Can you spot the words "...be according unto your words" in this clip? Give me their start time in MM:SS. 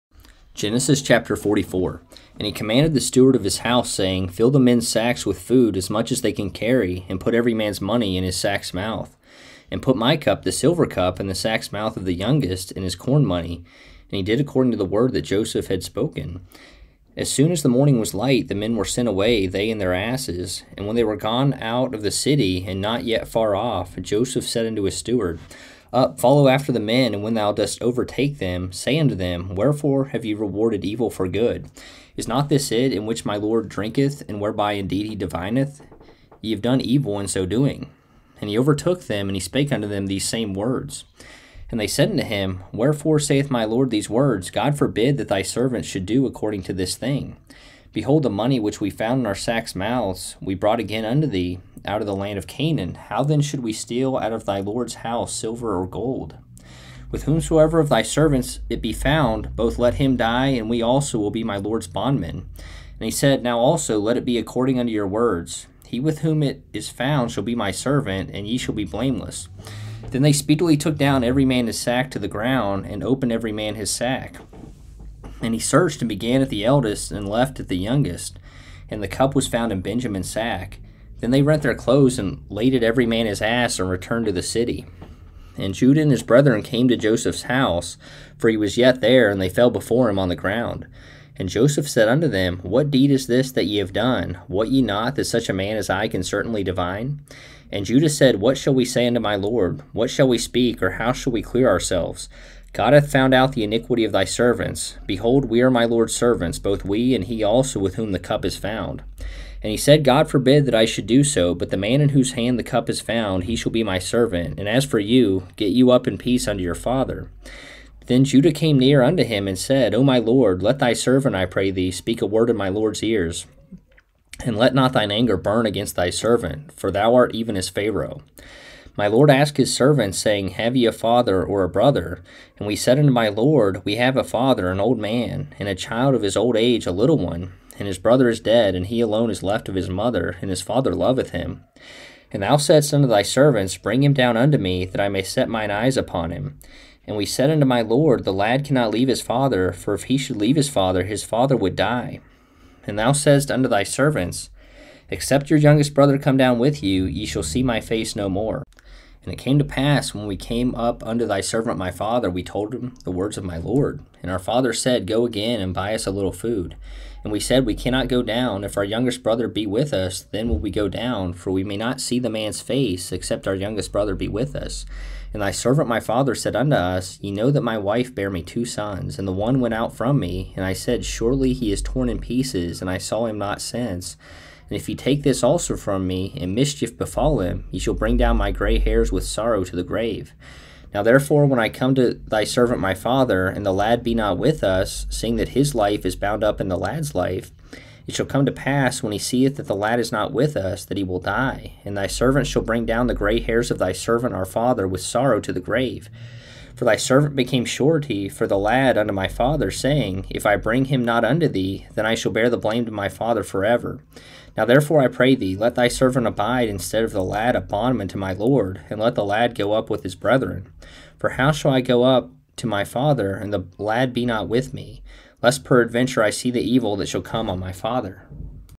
01:04.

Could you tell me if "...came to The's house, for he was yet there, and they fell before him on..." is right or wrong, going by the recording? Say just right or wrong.
wrong.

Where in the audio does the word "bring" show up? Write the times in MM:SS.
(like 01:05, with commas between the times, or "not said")
02:23, 03:07, 03:22, 03:30.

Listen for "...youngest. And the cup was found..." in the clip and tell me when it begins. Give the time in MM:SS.
01:17.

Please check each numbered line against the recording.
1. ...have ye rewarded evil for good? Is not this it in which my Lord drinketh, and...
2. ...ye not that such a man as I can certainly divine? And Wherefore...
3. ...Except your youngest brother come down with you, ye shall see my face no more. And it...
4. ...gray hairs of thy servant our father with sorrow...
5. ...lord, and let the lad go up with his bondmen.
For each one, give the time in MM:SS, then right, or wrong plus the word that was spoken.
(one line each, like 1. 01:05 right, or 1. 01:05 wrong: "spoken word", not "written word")
1. 00:30 right
2. 01:34 wrong: "Judah", not "Wherefore"
3. 02:35 right
4. 03:23 right
5. 03:38 wrong: "brethren", not "bondmen".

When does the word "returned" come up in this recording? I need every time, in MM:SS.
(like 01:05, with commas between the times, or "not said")
01:23.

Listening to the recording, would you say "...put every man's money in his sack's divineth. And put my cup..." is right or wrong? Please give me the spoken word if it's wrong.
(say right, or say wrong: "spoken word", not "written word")
wrong: "mouth", not "divineth".